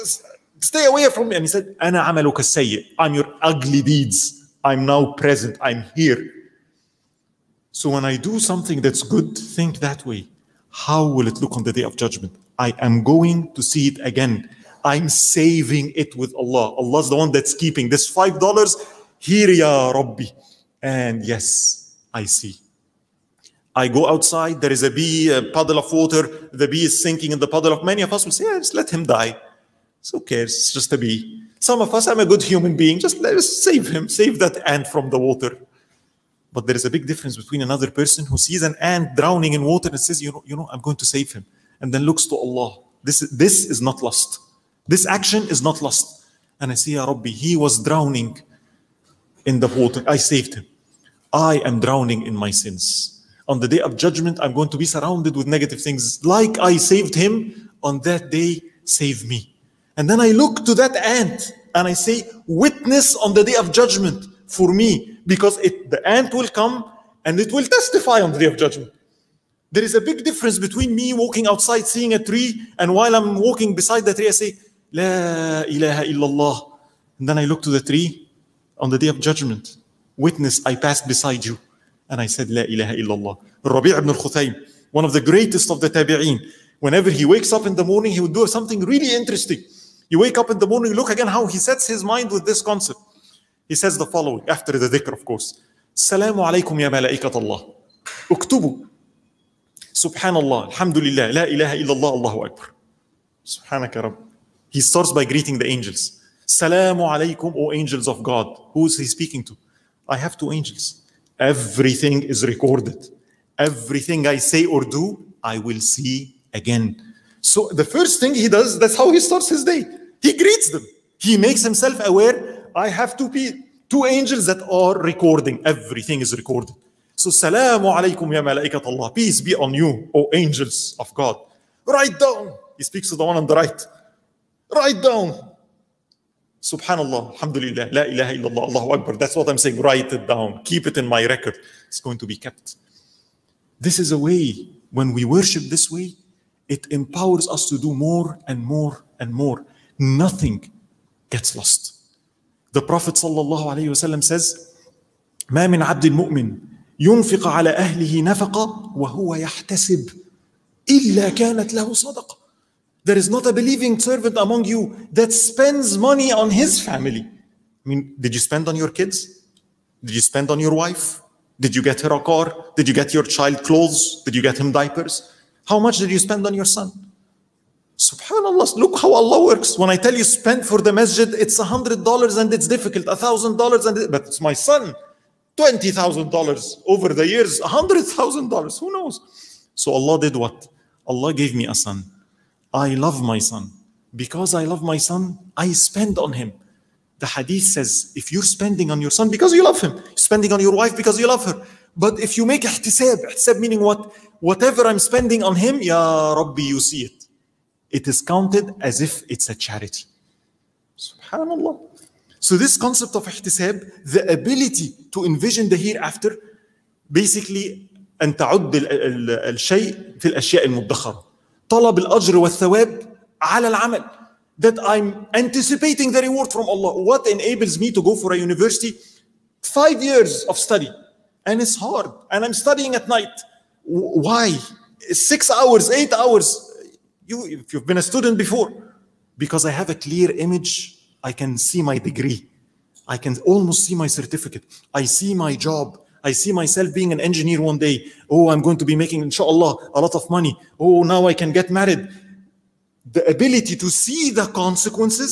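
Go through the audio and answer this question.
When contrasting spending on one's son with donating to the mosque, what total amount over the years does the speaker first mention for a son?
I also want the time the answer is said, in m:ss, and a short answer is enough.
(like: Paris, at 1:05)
$20,000, at 3:05.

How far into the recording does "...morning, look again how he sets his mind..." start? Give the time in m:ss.
1:30.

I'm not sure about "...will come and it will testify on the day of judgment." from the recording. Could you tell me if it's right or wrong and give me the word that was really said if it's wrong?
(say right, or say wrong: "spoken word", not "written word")
right.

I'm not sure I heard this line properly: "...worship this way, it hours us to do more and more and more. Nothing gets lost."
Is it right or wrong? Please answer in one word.
wrong.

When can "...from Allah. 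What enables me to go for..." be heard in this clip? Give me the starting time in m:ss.
3:46.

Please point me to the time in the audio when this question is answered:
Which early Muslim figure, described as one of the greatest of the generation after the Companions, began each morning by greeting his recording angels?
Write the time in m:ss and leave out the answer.
1:23.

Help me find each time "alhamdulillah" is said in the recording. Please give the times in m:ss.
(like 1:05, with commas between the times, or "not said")
1:40, 2:17.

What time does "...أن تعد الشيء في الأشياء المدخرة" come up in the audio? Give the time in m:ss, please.
3:38.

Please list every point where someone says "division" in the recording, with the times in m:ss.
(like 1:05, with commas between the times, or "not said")
not said.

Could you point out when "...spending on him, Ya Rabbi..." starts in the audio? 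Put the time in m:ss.
3:24.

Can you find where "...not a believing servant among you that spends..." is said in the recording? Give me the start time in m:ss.
2:43.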